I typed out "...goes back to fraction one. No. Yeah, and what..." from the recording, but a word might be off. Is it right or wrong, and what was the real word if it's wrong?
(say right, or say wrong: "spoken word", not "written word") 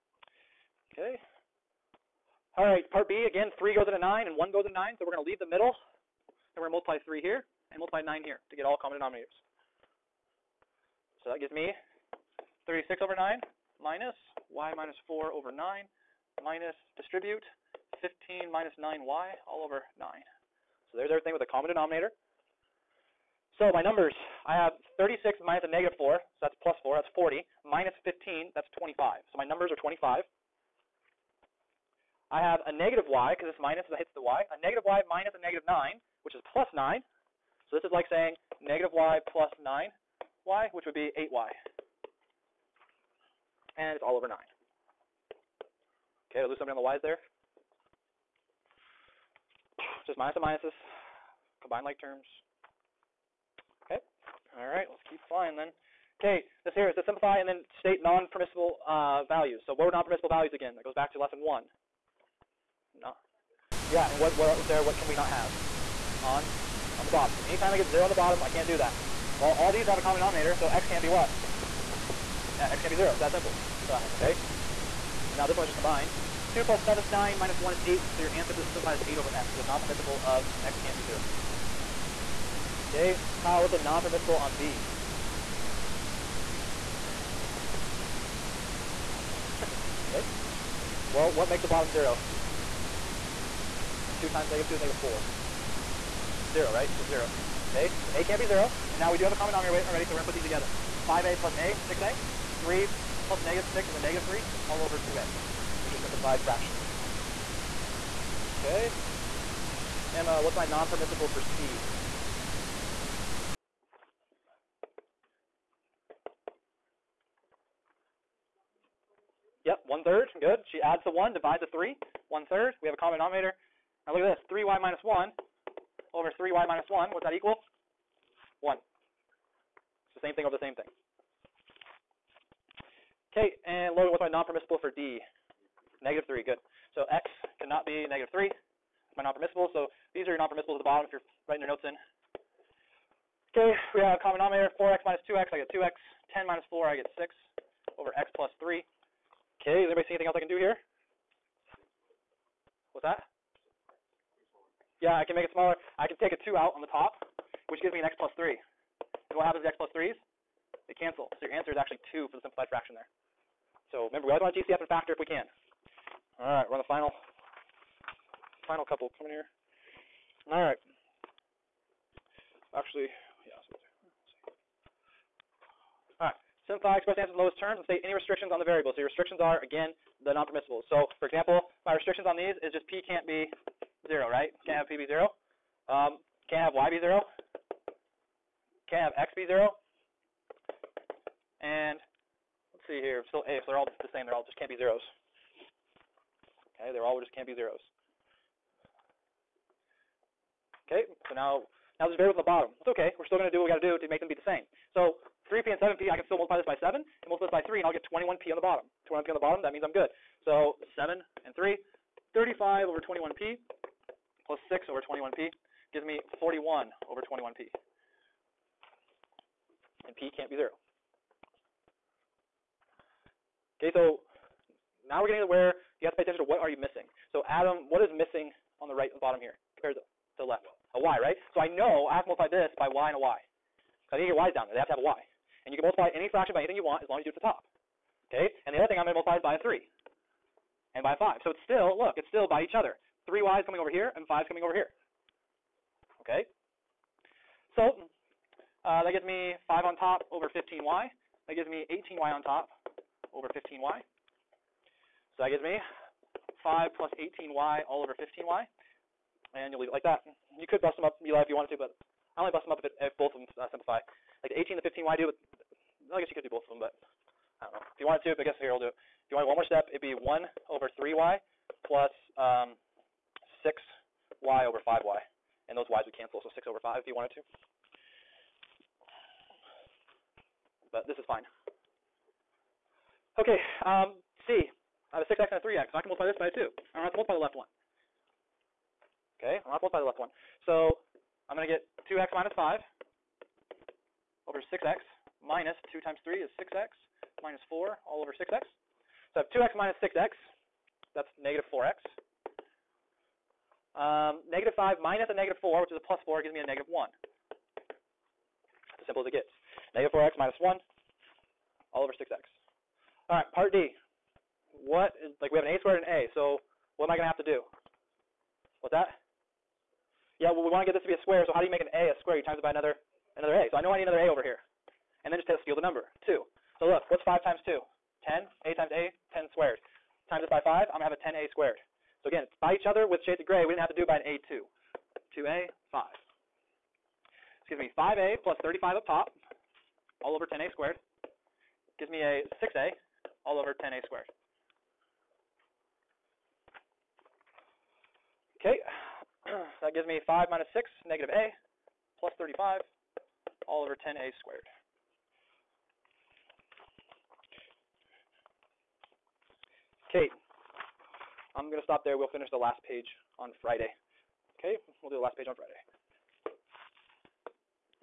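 wrong: "lesson", not "fraction".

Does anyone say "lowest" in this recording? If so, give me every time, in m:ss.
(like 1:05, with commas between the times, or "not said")
2:57.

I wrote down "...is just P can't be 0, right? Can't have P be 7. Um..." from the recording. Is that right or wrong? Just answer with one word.
wrong.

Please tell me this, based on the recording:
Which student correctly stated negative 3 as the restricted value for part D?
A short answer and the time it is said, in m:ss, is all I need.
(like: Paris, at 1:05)
Logan, at 2:13.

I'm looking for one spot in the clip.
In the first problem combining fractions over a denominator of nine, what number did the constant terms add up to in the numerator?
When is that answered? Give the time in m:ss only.
0:29.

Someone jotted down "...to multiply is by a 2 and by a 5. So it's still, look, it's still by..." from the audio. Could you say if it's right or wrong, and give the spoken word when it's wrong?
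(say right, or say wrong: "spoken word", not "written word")
wrong: "3", not "2".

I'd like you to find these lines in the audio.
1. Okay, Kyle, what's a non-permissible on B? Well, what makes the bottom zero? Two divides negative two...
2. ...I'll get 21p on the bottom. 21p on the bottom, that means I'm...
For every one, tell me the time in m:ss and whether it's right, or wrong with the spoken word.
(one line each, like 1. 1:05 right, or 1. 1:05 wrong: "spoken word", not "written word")
1. 1:22 wrong: "times", not "divides"
2. 3:27 right.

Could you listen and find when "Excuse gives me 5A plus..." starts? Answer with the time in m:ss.
5:37.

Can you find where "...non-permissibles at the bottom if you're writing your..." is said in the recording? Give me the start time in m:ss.
2:20.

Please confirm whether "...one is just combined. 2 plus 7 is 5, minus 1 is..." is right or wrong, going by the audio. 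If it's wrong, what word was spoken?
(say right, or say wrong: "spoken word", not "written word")
wrong: "9", not "5".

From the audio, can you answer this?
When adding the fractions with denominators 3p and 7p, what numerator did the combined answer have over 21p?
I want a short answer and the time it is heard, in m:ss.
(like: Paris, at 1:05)
41, at 3:36.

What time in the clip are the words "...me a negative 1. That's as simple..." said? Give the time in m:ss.
5:06.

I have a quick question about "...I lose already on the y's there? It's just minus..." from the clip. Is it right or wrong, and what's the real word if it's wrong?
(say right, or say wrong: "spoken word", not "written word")
wrong: "somebody", not "already".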